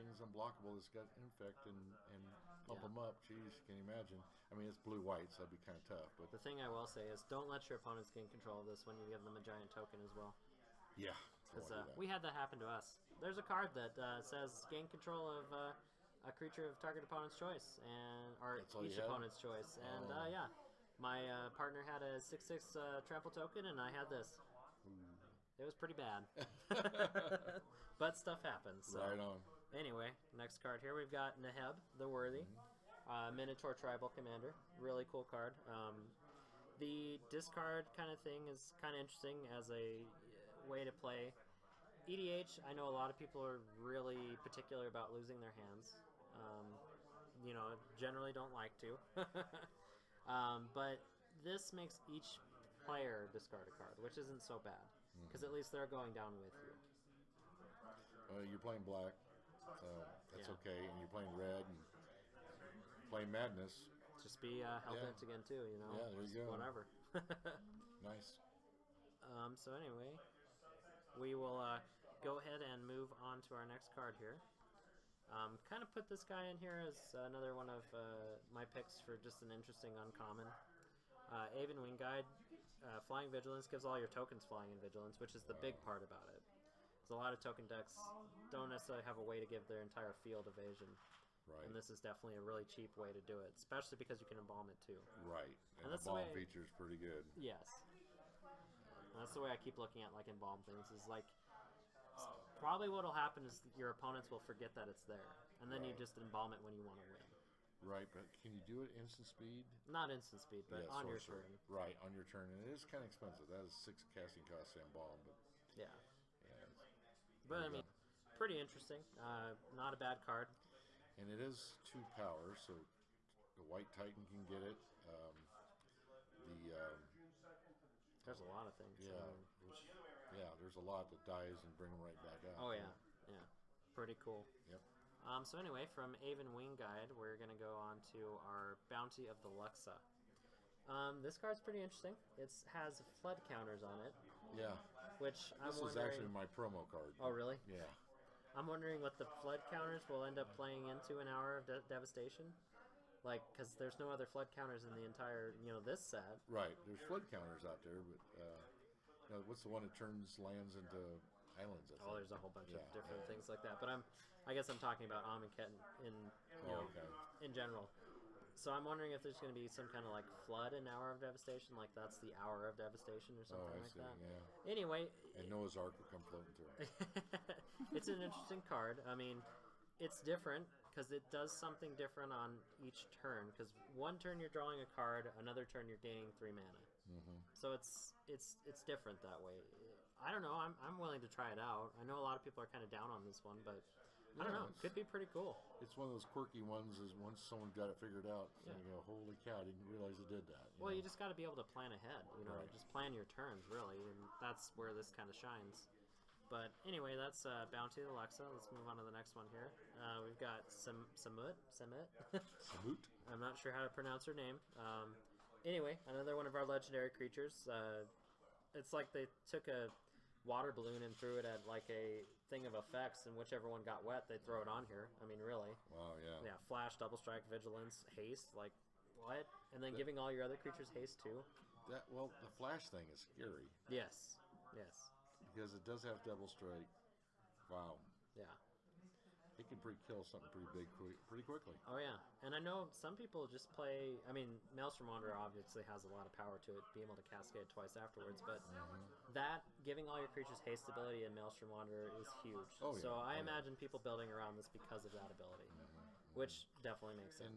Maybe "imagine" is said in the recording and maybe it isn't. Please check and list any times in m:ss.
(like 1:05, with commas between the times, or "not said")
0:03, 4:13.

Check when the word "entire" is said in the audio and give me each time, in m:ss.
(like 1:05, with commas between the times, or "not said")
1:29, 2:35.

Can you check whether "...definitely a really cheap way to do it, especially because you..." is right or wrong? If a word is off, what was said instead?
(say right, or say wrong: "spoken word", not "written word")
right.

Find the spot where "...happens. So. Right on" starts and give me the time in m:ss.
0:28.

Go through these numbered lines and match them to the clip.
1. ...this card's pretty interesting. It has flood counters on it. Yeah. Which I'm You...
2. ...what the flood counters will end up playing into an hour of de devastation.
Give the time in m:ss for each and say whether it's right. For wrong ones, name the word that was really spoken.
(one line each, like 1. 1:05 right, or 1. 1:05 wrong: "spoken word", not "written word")
1. 2:21 wrong: "This", not "You"
2. 2:29 right.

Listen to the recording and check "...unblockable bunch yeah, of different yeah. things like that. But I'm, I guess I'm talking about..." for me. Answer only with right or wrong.
wrong.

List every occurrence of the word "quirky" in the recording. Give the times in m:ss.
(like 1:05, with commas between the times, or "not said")
3:16.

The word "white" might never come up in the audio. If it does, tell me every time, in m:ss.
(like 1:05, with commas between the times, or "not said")
0:05, 2:03.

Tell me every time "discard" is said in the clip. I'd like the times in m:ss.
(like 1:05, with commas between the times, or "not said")
0:37, 0:53.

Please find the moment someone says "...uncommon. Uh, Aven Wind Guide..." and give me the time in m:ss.
1:19.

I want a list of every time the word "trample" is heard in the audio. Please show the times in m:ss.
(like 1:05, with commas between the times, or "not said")
0:23.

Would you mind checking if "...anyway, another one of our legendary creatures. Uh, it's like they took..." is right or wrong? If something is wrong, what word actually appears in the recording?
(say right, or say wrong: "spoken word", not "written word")
right.